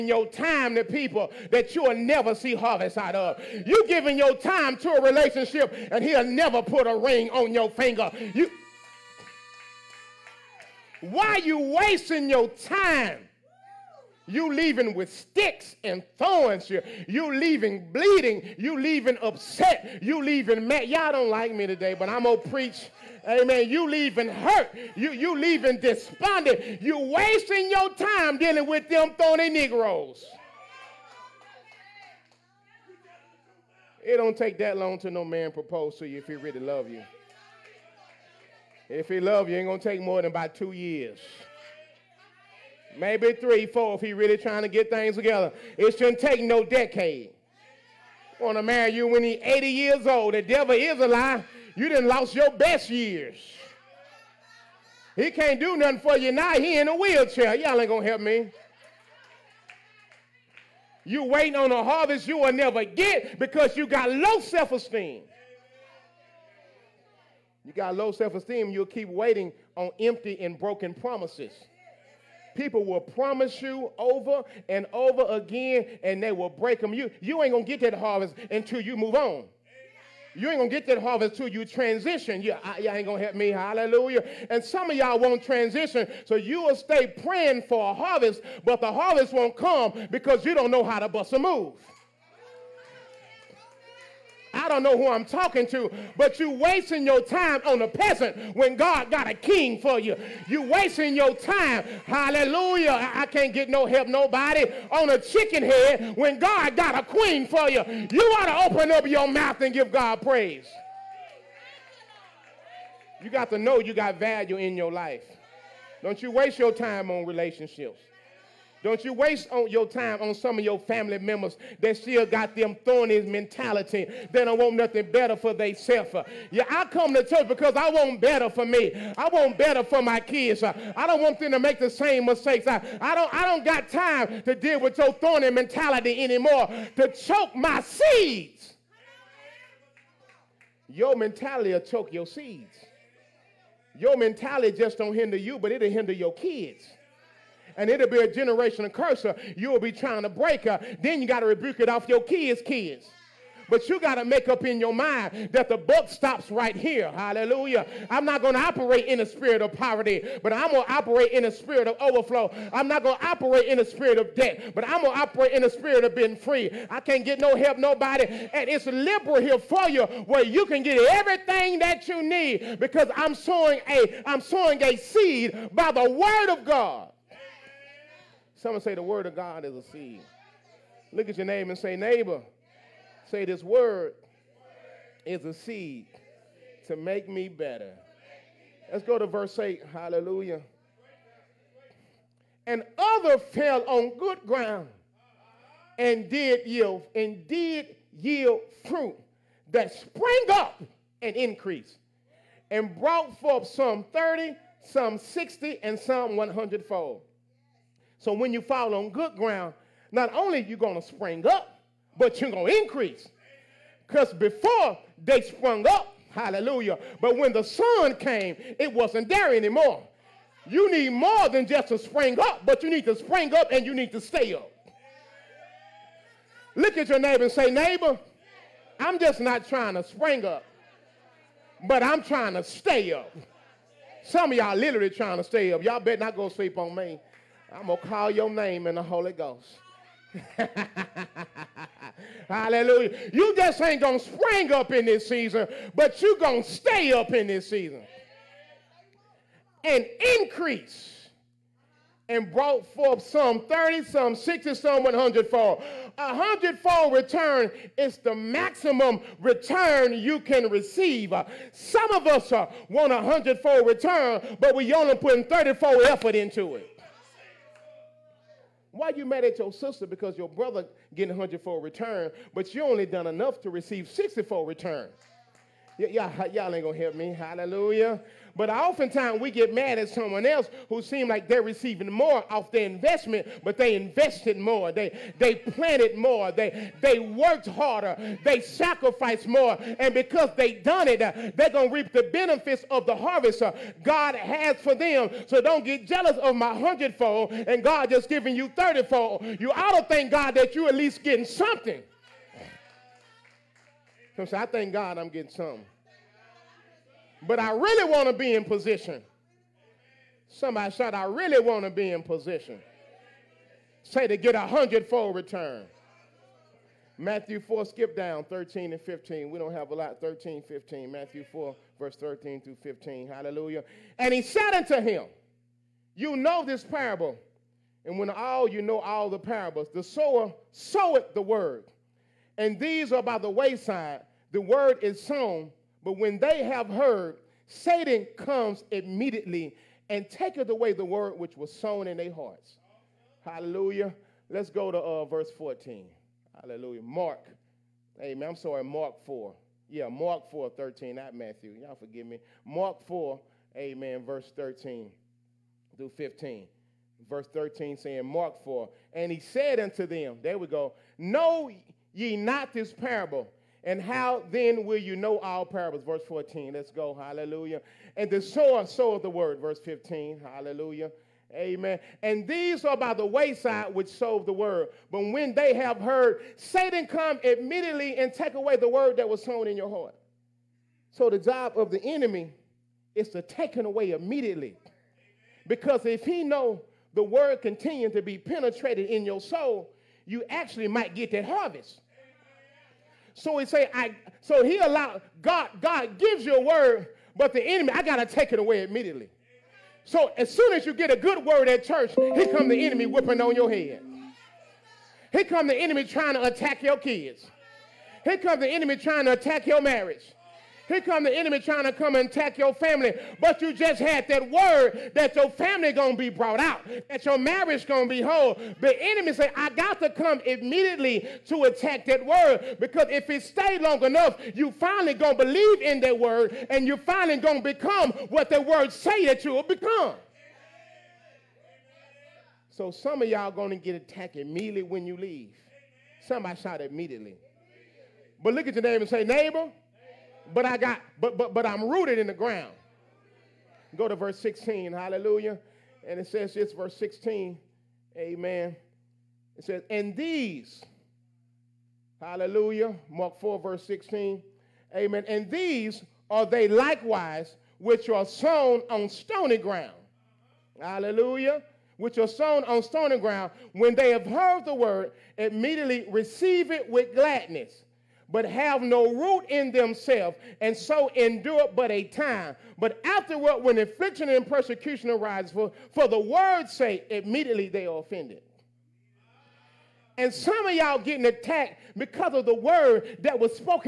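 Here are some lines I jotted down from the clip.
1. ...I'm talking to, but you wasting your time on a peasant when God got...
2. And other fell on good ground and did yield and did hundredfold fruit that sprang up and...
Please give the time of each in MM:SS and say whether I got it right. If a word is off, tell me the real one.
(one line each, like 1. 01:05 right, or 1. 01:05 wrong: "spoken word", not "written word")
1. 01:35 right
2. 03:12 wrong: "yield", not "hundredfold".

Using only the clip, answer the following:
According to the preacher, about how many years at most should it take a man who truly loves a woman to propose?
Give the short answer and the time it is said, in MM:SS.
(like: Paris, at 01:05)
2 years, at 00:40.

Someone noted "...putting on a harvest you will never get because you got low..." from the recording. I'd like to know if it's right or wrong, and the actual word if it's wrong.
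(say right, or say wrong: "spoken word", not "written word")
wrong: "waiting", not "putting".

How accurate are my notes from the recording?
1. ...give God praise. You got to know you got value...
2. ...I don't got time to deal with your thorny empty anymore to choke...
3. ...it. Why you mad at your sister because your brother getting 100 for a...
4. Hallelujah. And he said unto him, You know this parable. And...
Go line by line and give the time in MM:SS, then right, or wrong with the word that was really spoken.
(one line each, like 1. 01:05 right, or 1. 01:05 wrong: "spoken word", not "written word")
1. 01:49 right
2. 02:13 wrong: "mentality", not "empty"
3. 04:26 right
4. 05:23 right.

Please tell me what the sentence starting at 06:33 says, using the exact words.
So he say, I so he allowed God, God gives you a word, but the enemy, I gotta take it away immediately.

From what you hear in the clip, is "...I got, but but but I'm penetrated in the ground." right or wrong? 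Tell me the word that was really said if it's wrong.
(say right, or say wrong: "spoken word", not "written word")
wrong: "rooted", not "penetrated".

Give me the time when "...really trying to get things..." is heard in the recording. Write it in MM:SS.
00:44.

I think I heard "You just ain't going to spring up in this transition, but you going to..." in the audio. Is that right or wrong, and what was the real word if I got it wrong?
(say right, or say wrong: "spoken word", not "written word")
wrong: "season", not "transition".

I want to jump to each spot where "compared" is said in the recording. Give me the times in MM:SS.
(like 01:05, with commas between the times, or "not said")
not said.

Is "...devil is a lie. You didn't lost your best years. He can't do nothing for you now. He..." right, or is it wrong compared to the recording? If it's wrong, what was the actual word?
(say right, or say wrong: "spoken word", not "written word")
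right.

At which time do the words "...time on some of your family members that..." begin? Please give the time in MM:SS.
01:59.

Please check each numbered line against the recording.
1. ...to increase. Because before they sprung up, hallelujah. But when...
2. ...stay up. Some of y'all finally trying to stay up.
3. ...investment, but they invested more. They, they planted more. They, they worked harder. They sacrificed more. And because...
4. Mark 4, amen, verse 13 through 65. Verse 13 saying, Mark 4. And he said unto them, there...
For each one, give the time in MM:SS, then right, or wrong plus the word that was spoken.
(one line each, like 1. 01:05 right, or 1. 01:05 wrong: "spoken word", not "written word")
1. 03:32 right
2. 03:52 wrong: "literally", not "finally"
3. 04:42 right
4. 05:52 wrong: "15", not "65".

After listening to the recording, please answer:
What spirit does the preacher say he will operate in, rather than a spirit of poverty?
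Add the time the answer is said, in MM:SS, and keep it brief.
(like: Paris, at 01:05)
overflow, at 02:42.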